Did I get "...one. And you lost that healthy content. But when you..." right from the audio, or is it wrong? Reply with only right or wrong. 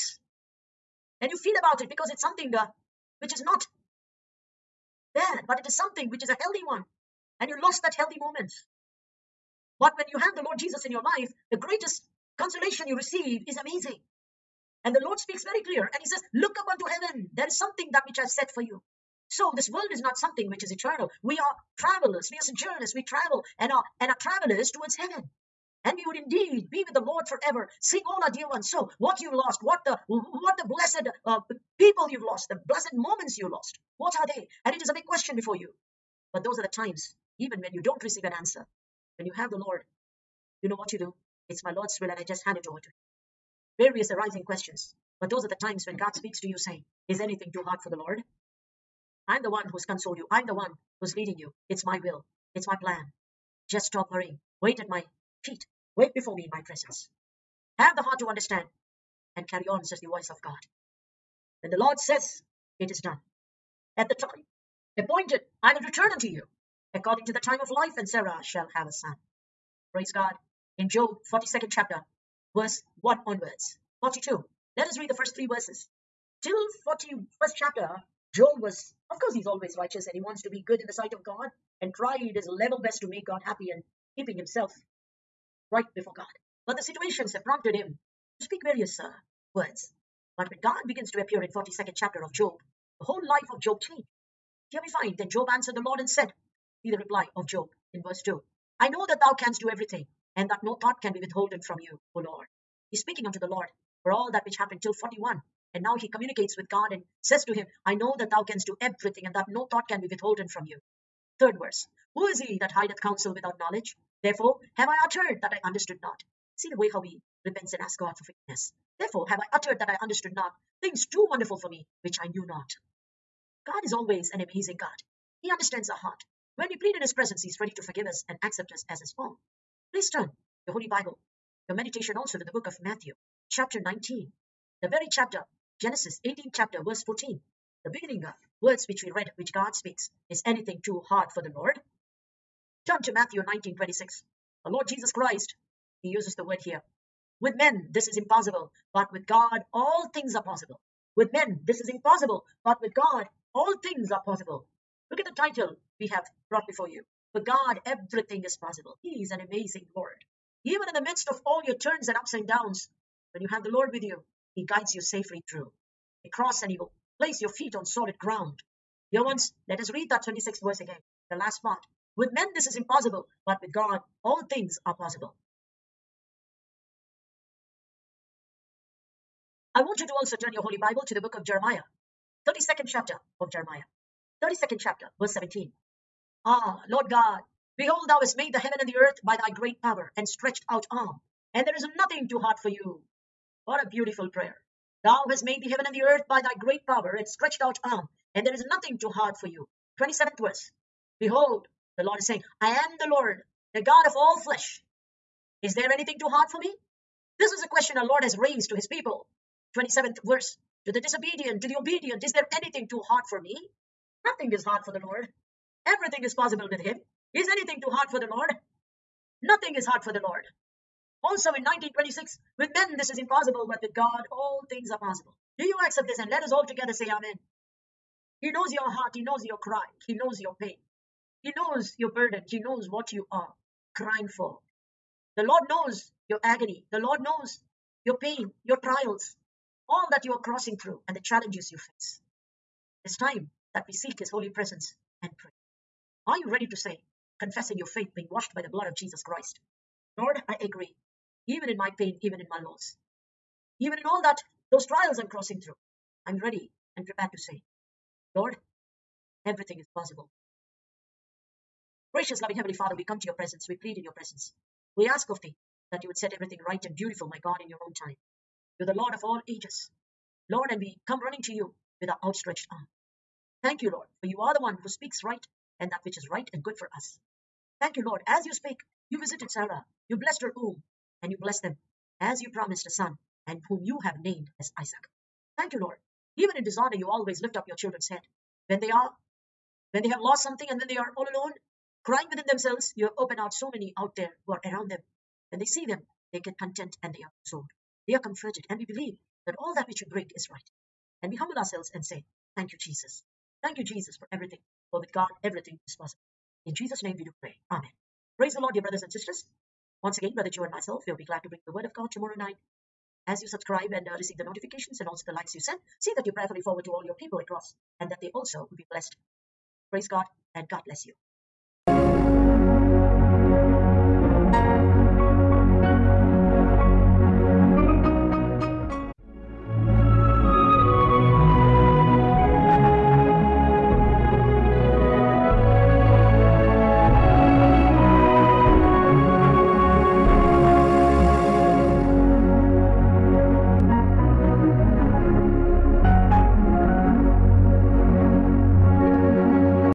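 wrong.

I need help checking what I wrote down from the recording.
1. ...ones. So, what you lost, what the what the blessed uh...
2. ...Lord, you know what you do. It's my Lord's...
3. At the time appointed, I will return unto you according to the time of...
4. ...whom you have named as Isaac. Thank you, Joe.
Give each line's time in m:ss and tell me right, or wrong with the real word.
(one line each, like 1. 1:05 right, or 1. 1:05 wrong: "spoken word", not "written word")
1. 0:28 right
2. 0:39 right
3. 1:03 right
4. 4:43 wrong: "Lord", not "Joe".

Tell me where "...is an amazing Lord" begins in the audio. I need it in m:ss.
2:39.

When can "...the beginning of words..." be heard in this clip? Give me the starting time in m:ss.
2:17.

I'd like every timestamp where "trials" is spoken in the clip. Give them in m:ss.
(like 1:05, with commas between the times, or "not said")
3:58, 4:14.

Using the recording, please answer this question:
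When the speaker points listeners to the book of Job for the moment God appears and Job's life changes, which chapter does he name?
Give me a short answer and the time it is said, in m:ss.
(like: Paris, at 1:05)
42nd chapter, at 1:11.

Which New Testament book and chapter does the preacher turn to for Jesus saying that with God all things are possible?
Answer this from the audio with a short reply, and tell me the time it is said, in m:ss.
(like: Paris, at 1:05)
Matthew 19, at 2:23.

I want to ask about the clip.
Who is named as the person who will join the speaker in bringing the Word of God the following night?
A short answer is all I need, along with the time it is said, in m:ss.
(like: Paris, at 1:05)
Brother Joe, at 5:10.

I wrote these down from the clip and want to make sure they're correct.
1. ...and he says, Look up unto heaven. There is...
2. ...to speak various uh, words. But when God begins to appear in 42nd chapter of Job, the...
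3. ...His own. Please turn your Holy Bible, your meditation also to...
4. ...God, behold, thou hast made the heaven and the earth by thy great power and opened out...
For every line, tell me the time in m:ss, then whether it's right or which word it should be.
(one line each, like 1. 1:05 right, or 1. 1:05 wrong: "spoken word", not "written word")
1. 0:15 right
2. 1:28 right
3. 2:08 right
4. 3:07 wrong: "stretched", not "opened".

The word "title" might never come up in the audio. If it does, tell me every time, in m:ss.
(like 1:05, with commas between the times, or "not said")
2:35.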